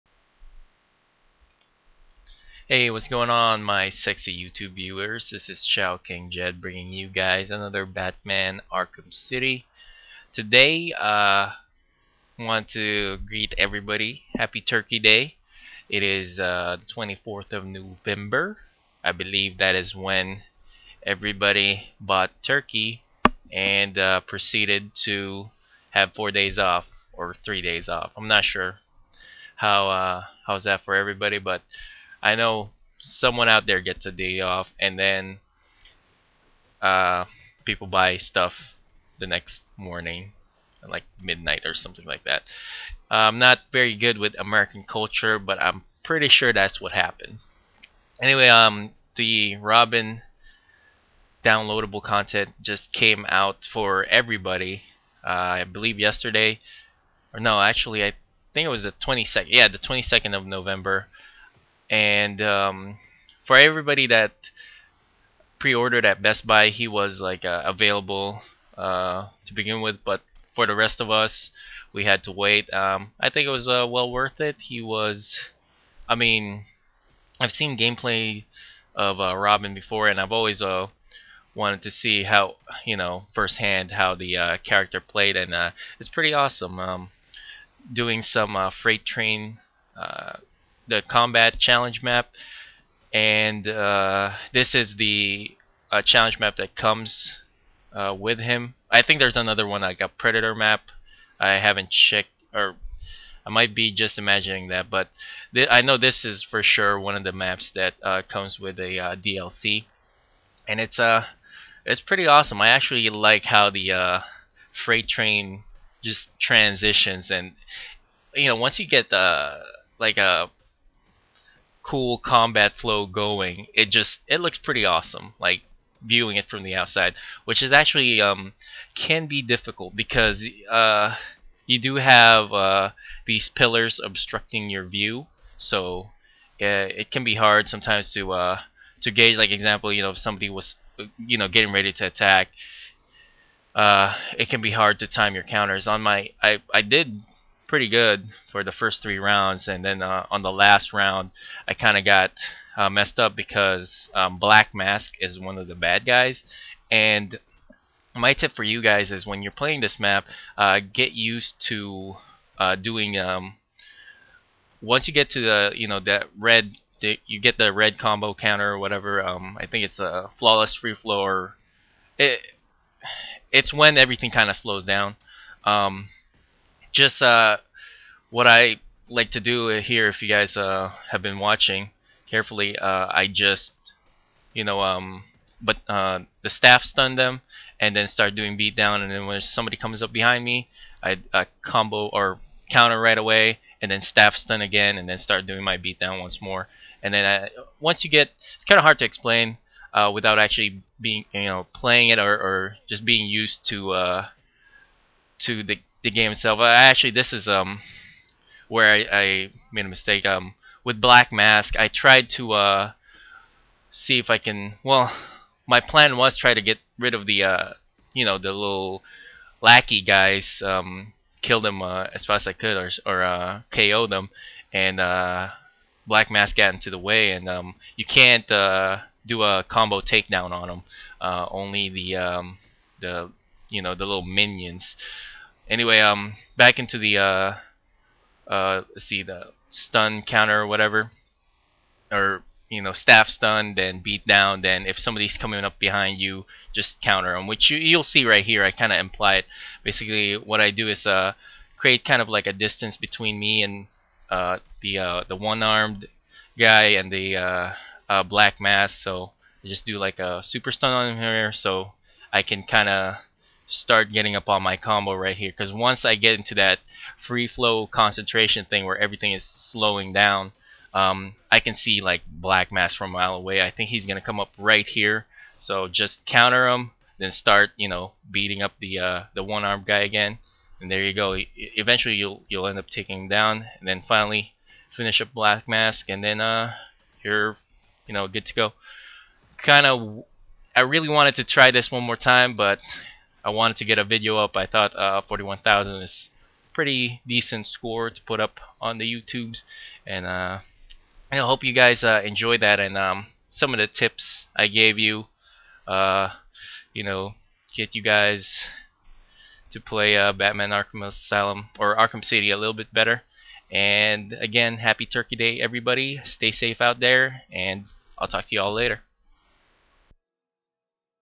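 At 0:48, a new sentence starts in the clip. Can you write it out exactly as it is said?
Anyway, um, the Robin downloadable content just came out for everybody.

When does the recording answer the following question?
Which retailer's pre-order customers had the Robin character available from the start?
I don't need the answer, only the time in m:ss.
1:06.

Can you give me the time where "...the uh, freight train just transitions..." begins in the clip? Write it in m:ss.
1:53.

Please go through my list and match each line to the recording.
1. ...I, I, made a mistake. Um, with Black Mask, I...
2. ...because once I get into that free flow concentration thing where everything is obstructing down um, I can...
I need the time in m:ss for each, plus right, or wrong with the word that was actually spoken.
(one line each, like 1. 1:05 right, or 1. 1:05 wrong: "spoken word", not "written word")
1. 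3:28 right
2. 4:25 wrong: "slowing", not "obstructing".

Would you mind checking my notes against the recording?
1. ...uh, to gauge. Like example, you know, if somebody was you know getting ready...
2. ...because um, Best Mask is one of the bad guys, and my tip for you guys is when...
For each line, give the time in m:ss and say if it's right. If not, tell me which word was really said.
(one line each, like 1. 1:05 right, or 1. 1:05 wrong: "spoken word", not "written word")
1. 2:18 right
2. 2:33 wrong: "Black", not "Best".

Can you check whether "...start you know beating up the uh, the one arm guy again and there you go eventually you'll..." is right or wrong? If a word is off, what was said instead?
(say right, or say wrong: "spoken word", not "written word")
right.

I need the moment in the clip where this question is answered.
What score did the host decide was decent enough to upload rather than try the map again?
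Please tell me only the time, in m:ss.
4:55.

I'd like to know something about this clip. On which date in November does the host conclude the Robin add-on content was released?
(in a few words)
22nd.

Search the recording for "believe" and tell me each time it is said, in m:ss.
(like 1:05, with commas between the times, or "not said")
0:19, 0:55.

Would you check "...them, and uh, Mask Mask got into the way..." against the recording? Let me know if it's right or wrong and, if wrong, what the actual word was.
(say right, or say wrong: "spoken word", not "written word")
wrong: "Black", not "Mask".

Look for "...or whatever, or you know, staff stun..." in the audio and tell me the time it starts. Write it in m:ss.
4:00.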